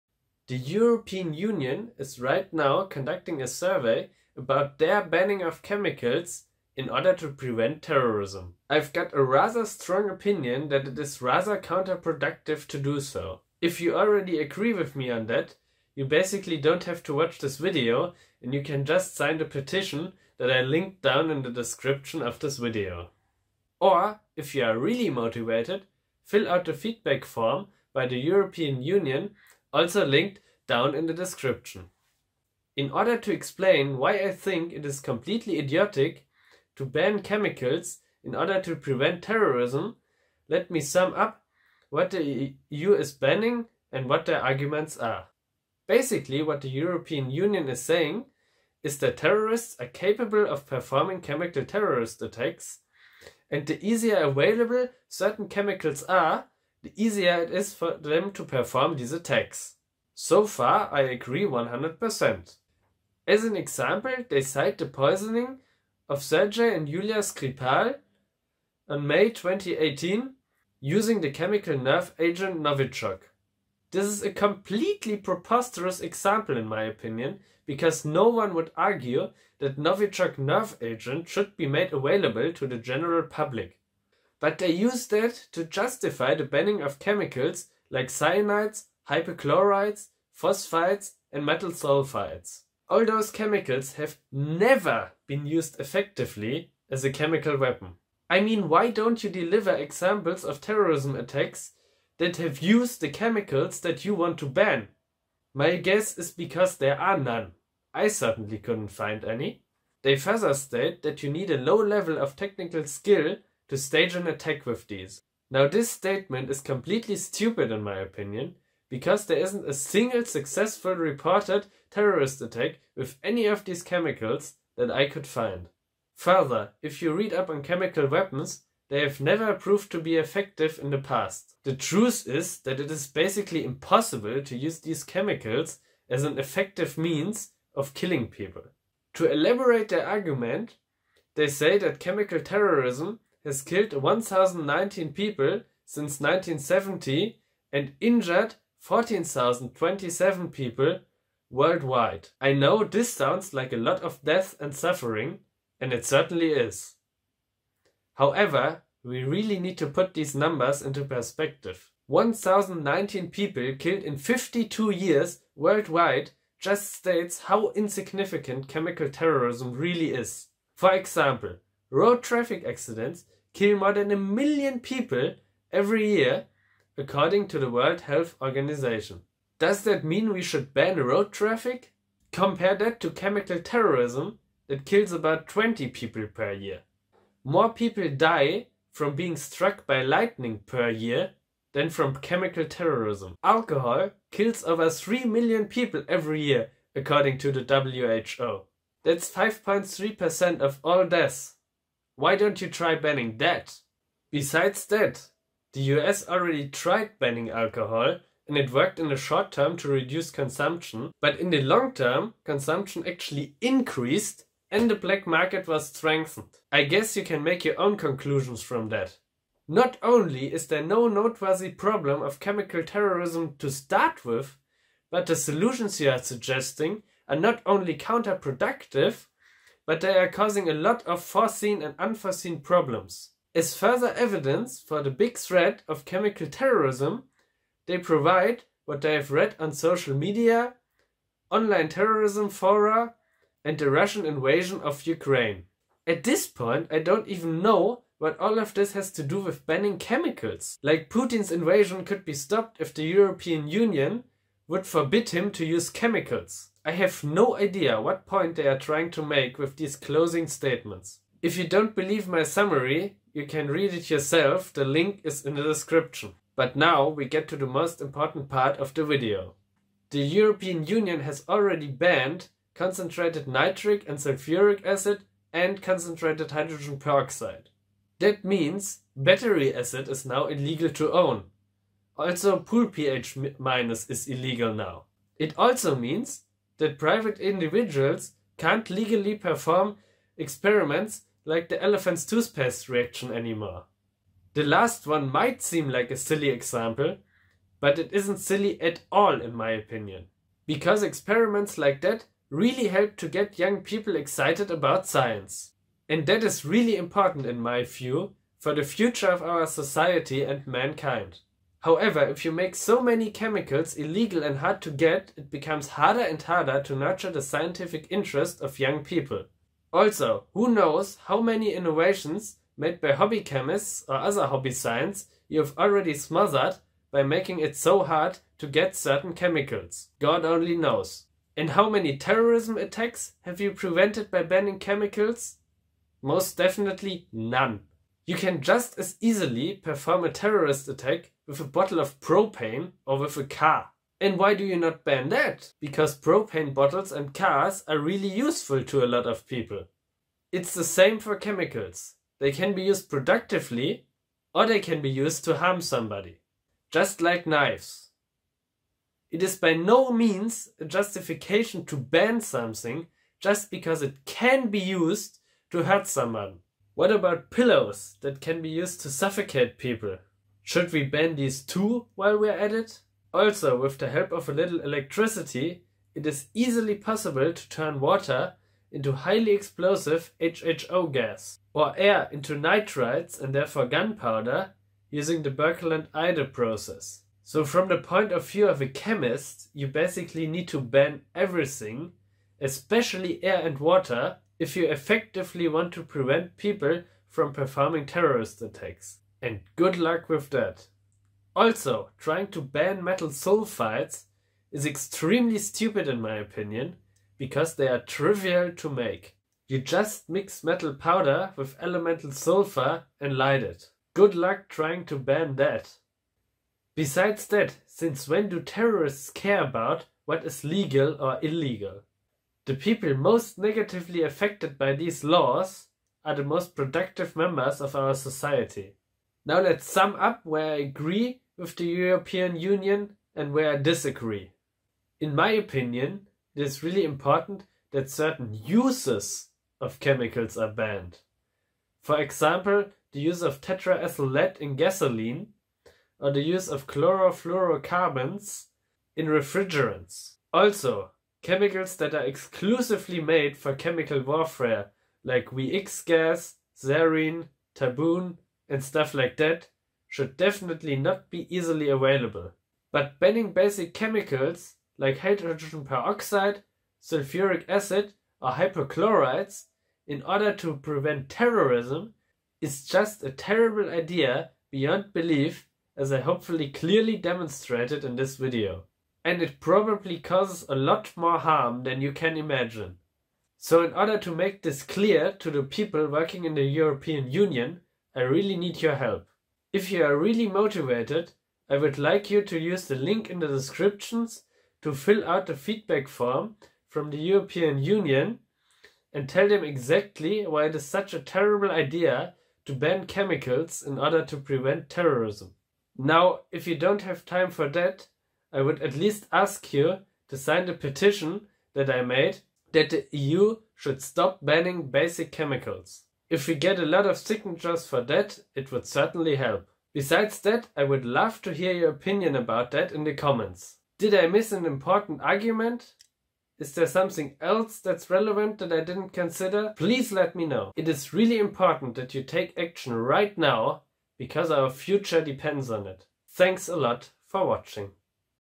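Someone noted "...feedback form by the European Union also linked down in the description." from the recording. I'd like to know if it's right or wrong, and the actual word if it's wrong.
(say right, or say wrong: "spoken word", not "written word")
right.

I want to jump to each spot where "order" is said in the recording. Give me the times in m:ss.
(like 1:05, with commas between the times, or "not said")
0:06, 0:32, 0:38, 7:50, 8:03, 8:23.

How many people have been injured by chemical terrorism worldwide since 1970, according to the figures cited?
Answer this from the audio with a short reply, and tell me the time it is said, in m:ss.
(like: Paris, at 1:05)
14,027, at 2:28.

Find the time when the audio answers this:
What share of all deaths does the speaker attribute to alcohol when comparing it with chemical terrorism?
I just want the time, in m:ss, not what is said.
3:19.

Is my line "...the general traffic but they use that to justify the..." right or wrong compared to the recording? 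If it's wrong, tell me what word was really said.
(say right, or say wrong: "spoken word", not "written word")
wrong: "public", not "traffic".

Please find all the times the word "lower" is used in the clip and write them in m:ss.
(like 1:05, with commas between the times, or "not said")
not said.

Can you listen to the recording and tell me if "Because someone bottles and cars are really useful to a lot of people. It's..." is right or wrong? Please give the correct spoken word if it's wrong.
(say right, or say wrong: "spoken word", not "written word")
wrong: "propane", not "someone".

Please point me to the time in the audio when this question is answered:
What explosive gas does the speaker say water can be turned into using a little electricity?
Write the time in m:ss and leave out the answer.
6:20.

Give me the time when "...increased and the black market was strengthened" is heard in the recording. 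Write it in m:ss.
3:33.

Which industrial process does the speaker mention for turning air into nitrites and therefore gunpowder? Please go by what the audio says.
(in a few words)
Birkeland-Eyde process.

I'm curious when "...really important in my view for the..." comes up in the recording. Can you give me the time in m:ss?
5:06.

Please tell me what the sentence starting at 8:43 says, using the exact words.
Did I miss an important argument?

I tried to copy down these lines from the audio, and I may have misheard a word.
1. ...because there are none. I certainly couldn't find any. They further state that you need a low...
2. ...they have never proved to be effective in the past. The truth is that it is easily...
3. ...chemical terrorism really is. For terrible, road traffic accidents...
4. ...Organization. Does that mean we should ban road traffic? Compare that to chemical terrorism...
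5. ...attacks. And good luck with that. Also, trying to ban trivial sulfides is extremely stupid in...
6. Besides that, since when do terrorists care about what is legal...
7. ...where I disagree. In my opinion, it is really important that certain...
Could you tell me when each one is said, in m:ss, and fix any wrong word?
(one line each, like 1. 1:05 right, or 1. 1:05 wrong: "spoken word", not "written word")
1. 1:46 right
2. 2:08 wrong: "basically", not "easily"
3. 2:48 wrong: "example", not "terrible"
4. 2:58 right
5. 6:38 wrong: "metal", not "trivial"
6. 6:56 right
7. 7:13 right.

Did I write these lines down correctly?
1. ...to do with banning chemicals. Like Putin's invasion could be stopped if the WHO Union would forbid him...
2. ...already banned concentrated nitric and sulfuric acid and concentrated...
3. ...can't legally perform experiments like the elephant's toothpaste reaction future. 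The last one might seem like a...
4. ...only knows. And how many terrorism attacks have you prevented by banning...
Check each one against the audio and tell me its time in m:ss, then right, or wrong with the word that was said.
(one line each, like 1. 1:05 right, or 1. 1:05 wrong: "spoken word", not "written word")
1. 4:09 wrong: "European", not "WHO"
2. 4:31 right
3. 4:48 wrong: "anymore", not "future"
4. 5:30 right.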